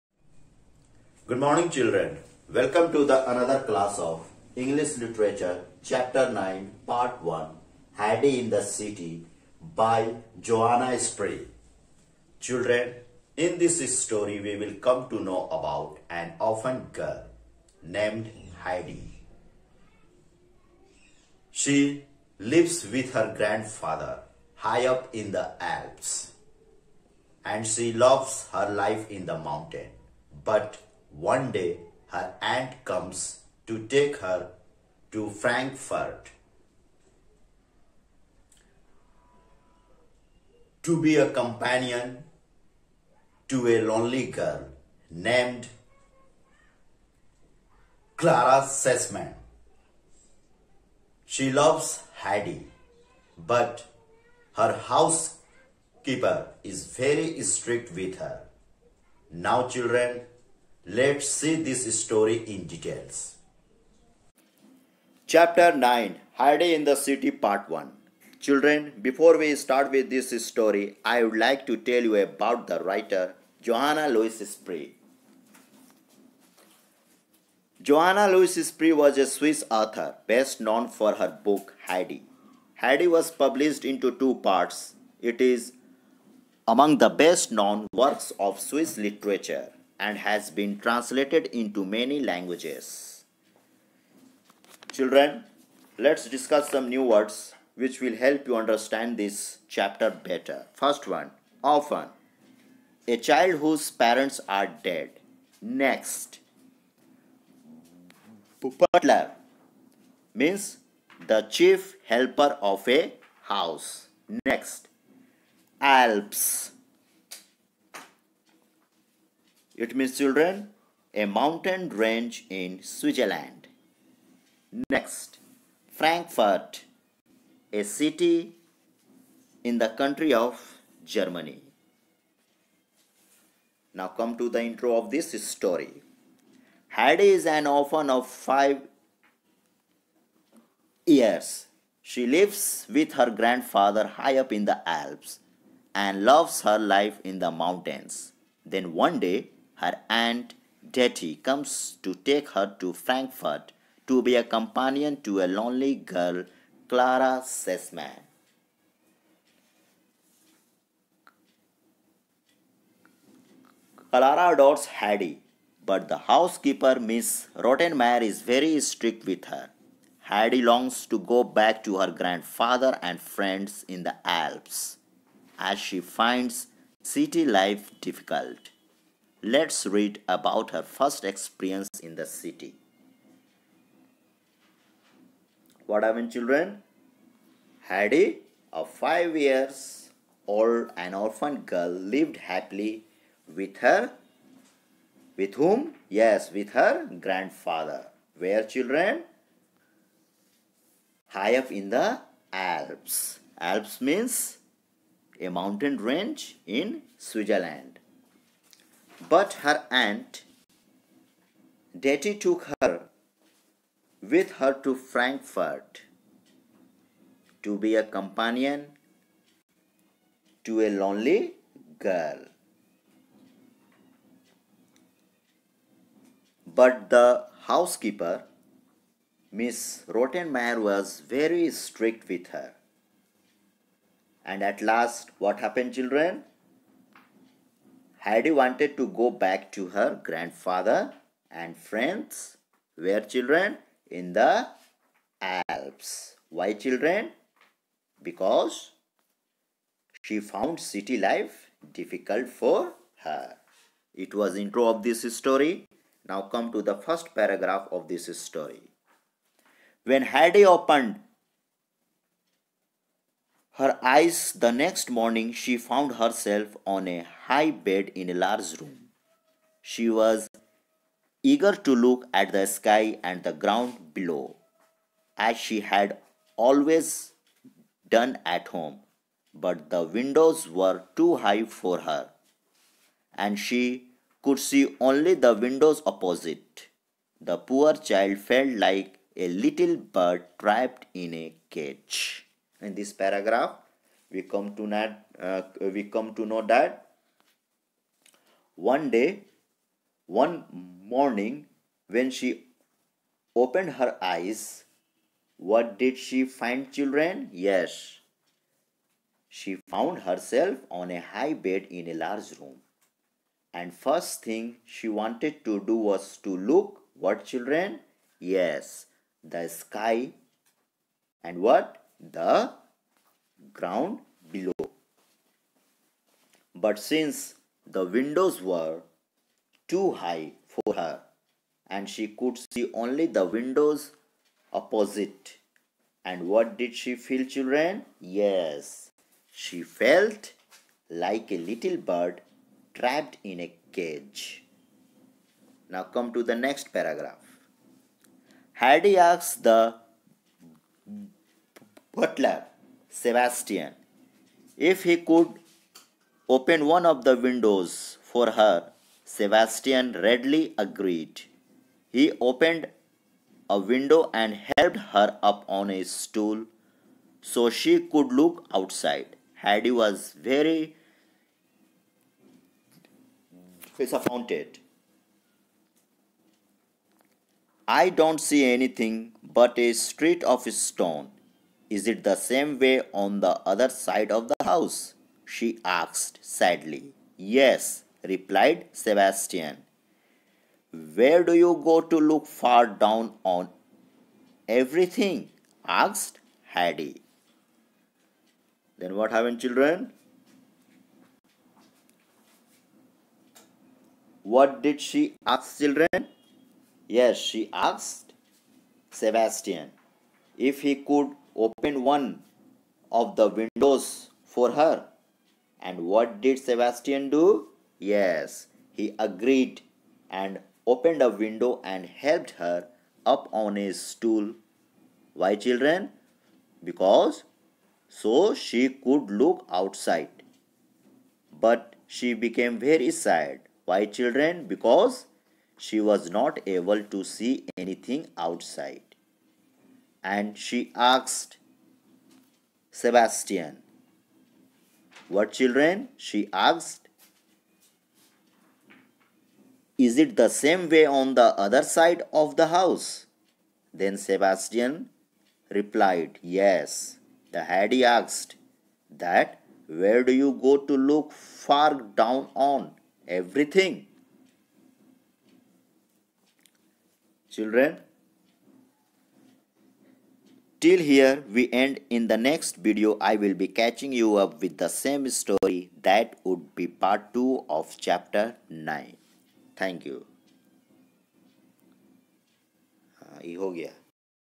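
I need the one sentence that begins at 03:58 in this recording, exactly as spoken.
Heidi wanted to go back to her grandfather and friends.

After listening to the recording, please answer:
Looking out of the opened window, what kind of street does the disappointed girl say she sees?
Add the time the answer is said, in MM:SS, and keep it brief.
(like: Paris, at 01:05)
a street of stone, at 06:19.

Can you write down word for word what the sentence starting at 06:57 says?
Yes, he agreed and opened a window and helped her up on his stool.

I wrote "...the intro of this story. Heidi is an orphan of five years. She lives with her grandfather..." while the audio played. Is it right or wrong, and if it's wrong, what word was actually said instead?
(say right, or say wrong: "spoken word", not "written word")
right.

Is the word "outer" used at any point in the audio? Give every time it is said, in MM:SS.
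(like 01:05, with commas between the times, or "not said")
not said.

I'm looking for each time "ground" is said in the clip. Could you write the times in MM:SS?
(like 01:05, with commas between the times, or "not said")
04:33, 05:23.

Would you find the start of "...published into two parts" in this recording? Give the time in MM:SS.
01:23.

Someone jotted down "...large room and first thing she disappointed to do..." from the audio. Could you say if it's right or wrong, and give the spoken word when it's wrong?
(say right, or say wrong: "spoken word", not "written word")
wrong: "wanted", not "disappointed".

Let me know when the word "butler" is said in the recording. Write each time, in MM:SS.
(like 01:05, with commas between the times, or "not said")
01:48, 05:52.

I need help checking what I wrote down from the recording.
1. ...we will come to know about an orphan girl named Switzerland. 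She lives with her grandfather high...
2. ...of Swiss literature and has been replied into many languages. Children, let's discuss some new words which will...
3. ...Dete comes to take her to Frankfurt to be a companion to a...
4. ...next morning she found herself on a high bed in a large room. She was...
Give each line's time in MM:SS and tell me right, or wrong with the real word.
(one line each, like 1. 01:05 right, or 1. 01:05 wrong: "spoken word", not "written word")
1. 00:14 wrong: "Heidi", not "Switzerland"
2. 01:28 wrong: "translated", not "replied"
3. 02:30 right
4. 04:24 right.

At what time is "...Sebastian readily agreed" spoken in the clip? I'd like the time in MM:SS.
05:59.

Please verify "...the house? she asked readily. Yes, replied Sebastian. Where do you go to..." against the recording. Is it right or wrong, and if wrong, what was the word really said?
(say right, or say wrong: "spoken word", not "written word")
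wrong: "sadly", not "readily".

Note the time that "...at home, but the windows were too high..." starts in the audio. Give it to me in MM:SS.
04:38.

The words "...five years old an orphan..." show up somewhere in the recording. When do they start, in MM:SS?
03:08.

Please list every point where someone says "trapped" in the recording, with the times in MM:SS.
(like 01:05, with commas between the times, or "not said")
04:50, 05:42.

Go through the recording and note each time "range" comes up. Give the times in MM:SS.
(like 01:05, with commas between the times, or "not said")
02:01, 03:25.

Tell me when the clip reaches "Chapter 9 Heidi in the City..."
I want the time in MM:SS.
01:05.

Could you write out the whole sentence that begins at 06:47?
Yes, she asked Sebastian if he could opened one of the windows for her.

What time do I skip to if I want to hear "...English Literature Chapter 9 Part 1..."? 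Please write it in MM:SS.
00:04.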